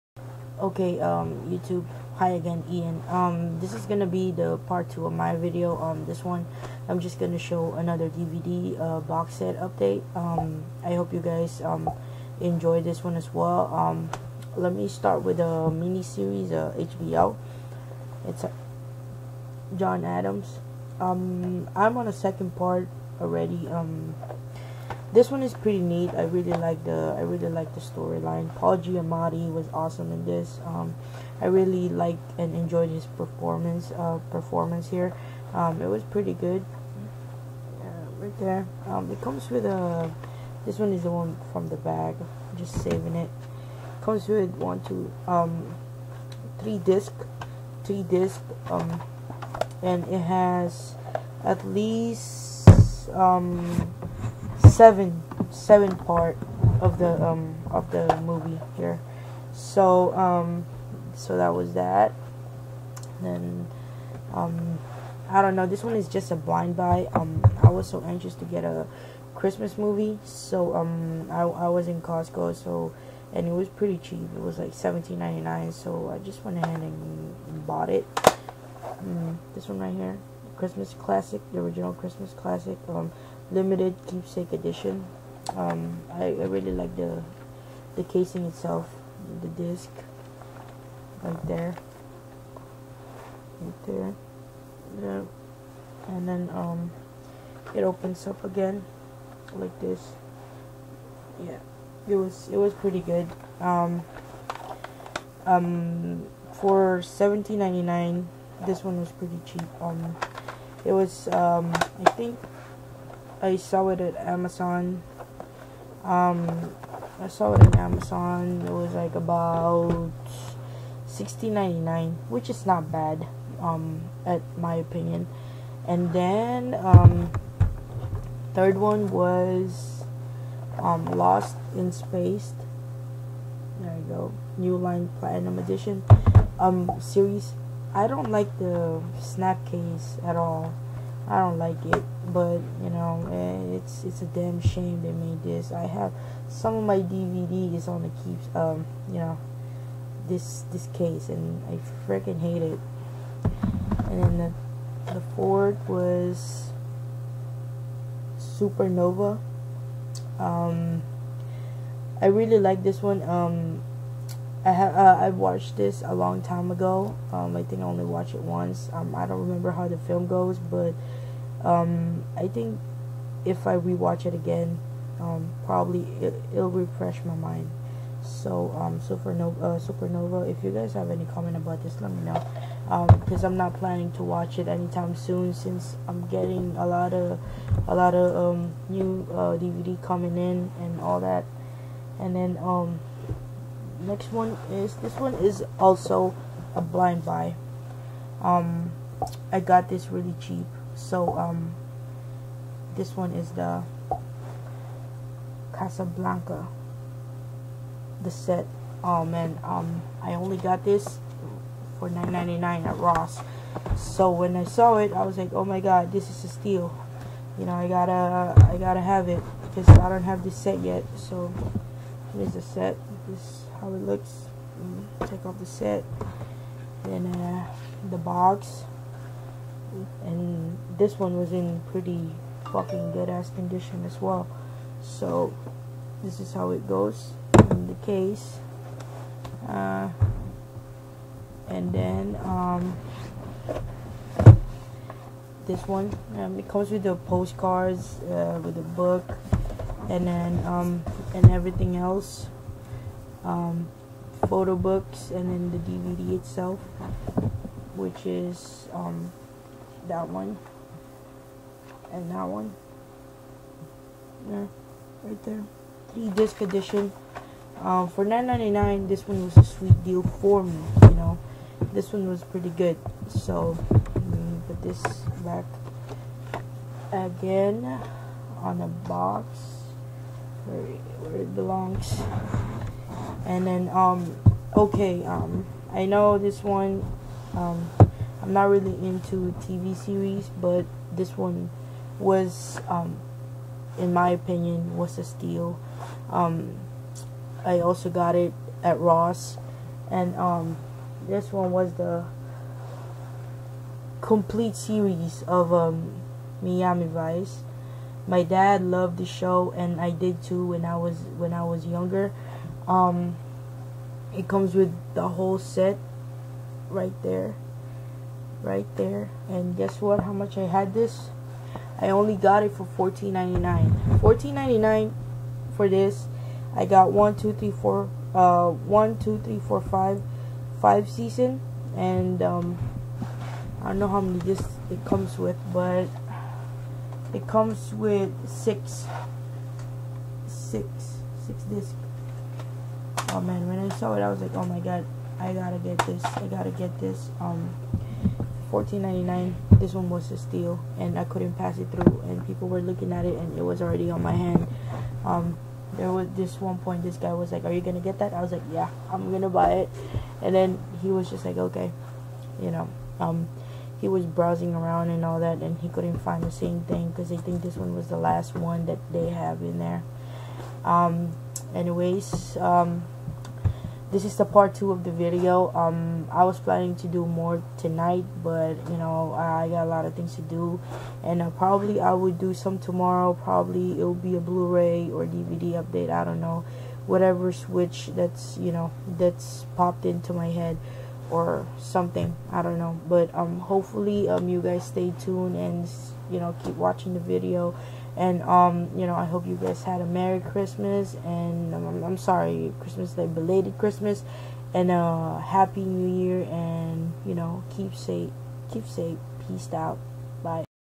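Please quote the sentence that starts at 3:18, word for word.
Um, I got this really cheap, so um, this one is the Casablanca, the set.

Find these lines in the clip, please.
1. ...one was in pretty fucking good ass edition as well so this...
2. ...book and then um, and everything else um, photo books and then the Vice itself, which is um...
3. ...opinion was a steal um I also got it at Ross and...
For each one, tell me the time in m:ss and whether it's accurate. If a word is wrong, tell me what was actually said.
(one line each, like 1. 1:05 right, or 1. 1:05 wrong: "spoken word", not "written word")
1. 3:51 wrong: "condition", not "edition"
2. 4:08 wrong: "DVD", not "Vice"
3. 4:54 right.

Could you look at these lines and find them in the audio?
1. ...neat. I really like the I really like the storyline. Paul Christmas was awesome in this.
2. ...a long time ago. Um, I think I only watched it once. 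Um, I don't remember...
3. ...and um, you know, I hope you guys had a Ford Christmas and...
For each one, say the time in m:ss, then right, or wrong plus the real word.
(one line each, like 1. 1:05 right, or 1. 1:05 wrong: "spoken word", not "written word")
1. 0:25 wrong: "Giamatti", not "Christmas"
2. 2:46 right
3. 6:38 wrong: "Merry", not "Ford".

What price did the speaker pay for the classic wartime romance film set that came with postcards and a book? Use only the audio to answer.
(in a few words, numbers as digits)
$9.99.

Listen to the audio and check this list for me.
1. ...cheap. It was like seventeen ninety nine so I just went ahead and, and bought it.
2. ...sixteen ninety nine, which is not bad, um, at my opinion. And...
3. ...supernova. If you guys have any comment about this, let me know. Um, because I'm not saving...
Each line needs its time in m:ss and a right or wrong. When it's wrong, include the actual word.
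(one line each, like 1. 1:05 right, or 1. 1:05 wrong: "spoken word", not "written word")
1. 1:13 right
2. 2:01 right
3. 2:59 wrong: "planning", not "saving".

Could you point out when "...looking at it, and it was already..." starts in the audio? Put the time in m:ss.
5:52.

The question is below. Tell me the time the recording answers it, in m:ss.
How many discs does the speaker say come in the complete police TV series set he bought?
5:38.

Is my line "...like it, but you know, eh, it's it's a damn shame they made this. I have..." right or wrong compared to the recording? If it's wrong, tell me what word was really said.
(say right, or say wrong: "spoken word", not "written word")
right.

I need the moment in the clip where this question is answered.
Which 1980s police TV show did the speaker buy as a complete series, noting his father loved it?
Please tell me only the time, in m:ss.
5:06.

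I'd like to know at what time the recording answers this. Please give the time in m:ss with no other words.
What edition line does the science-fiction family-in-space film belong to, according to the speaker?
2:14.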